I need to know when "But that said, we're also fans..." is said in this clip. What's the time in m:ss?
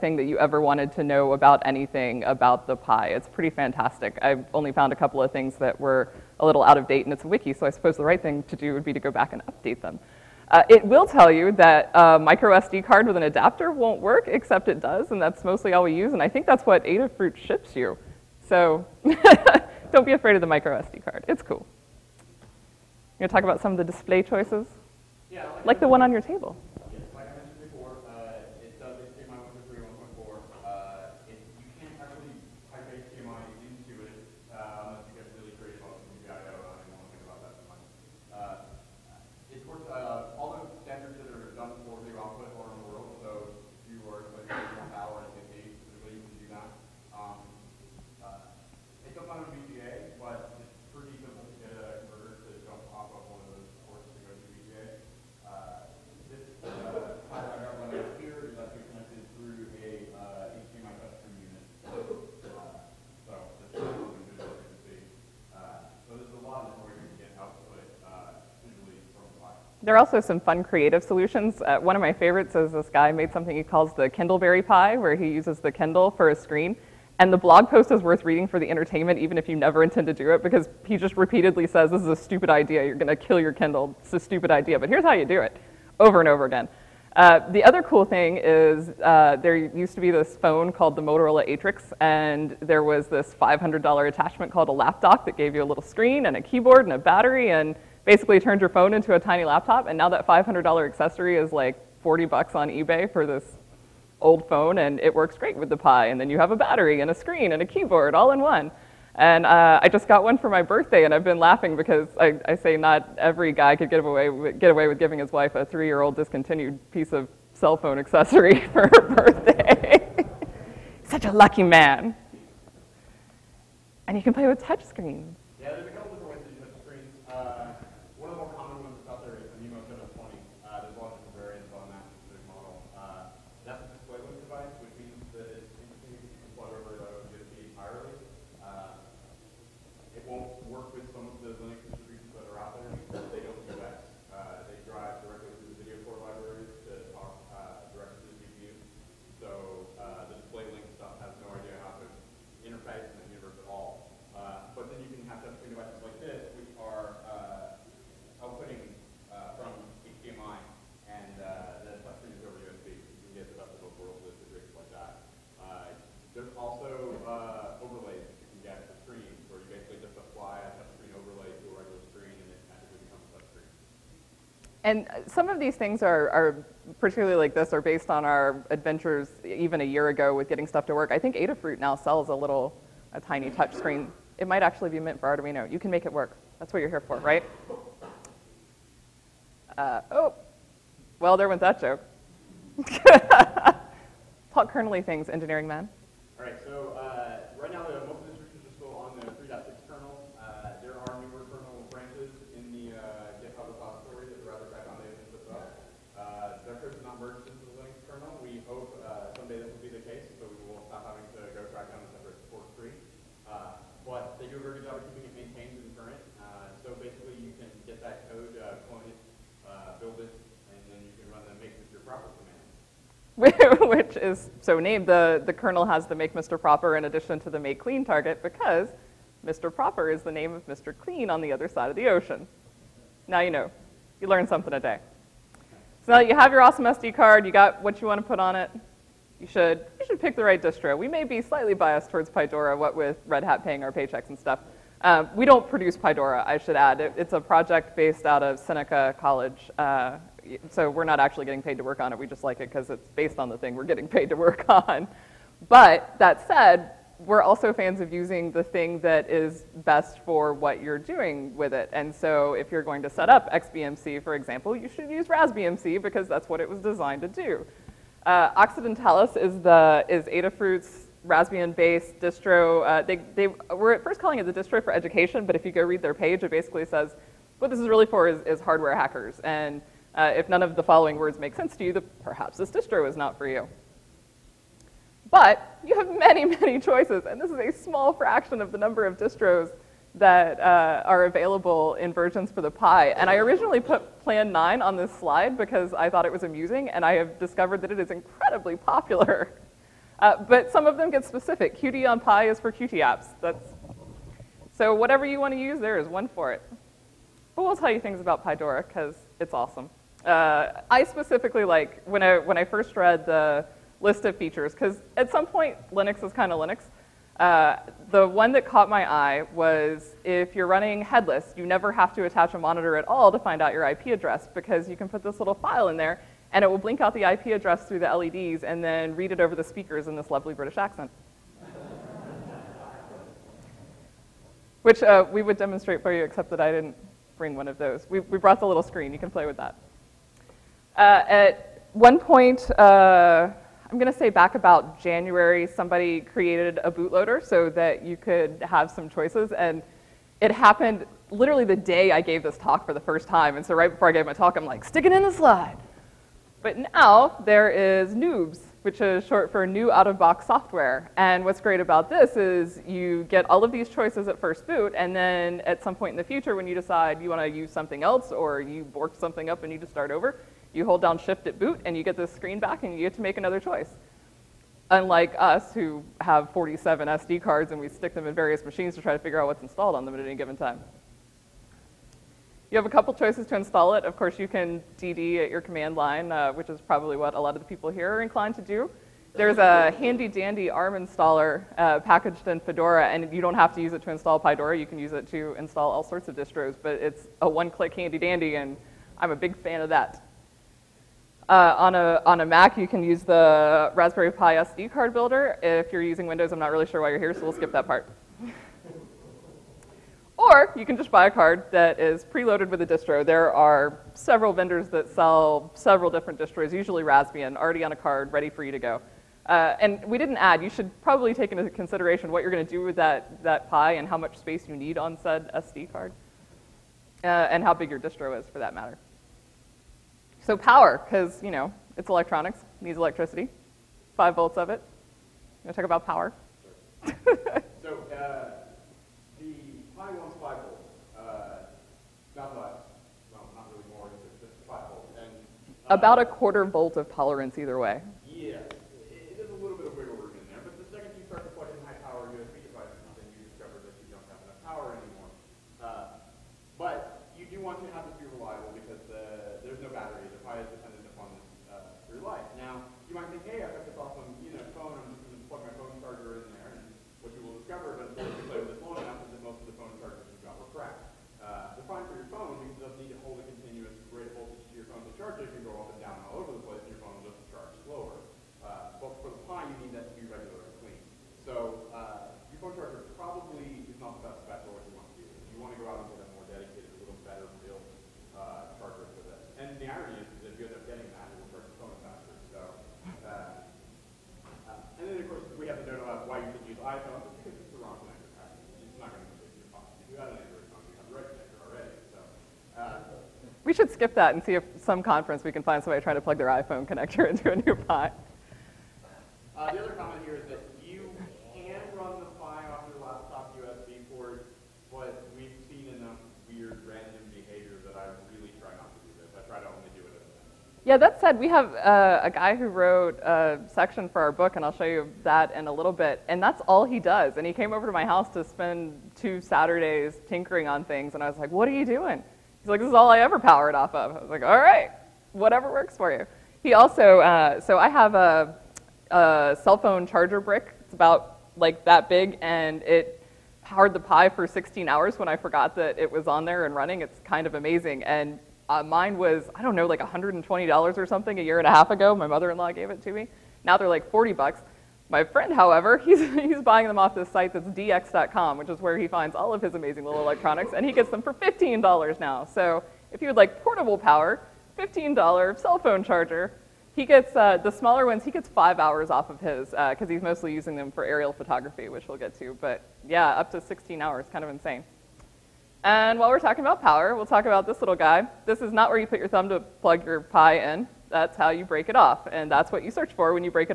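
4:15.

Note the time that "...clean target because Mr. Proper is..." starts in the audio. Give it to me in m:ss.
3:47.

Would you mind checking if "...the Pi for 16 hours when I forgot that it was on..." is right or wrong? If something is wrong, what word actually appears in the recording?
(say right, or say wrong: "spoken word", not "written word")
right.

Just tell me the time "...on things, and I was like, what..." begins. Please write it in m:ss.
8:50.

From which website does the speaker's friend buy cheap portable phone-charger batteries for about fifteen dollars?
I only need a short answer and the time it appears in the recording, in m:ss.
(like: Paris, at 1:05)
dx.com, at 9:17.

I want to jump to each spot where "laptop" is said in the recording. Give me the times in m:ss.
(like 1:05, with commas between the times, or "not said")
1:34, 1:39, 8:33.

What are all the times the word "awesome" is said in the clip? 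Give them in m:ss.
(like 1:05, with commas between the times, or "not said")
3:56, 5:09.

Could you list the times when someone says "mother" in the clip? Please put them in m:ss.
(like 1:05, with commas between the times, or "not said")
9:12.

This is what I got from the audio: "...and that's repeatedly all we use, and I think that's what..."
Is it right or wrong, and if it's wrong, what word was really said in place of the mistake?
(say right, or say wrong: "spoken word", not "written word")
wrong: "mostly", not "repeatedly".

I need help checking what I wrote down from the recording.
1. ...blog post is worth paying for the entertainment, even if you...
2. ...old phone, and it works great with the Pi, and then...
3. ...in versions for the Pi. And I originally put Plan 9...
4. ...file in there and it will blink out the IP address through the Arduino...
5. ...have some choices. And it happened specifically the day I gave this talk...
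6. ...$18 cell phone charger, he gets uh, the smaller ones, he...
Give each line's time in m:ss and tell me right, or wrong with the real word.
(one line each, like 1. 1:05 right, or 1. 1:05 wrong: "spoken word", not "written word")
1. 1:17 wrong: "reading", not "paying"
2. 1:44 right
3. 4:51 right
4. 5:25 wrong: "LEDs", not "Arduino"
5. 5:48 wrong: "literally", not "specifically"
6. 9:24 wrong: "15", not "18".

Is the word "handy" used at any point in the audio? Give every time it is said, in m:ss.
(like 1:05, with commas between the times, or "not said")
6:29, 6:37.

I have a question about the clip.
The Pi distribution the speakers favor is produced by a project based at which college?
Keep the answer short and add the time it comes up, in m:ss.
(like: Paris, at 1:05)
Seneca College, at 4:08.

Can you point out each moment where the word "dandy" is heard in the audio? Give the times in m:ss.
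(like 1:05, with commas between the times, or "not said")
6:30, 6:38.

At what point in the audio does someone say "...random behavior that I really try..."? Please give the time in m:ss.
8:36.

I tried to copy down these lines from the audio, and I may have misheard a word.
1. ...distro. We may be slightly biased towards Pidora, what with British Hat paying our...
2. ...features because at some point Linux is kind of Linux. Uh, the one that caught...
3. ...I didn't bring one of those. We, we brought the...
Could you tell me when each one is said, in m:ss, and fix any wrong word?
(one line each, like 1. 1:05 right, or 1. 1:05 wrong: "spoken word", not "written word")
1. 4:00 wrong: "Red", not "British"
2. 5:14 right
3. 5:36 right.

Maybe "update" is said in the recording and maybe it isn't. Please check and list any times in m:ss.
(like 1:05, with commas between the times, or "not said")
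0:09.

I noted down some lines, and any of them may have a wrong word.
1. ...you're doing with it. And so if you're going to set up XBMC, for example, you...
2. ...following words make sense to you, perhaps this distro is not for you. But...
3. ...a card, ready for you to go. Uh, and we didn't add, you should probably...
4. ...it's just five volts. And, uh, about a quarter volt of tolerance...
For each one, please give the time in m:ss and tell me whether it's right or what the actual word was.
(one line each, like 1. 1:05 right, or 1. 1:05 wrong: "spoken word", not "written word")
1. 4:20 right
2. 4:40 right
3. 6:57 right
4. 7:24 right.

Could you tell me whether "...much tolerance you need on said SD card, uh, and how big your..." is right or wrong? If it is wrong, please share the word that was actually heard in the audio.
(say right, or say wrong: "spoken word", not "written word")
wrong: "space", not "tolerance".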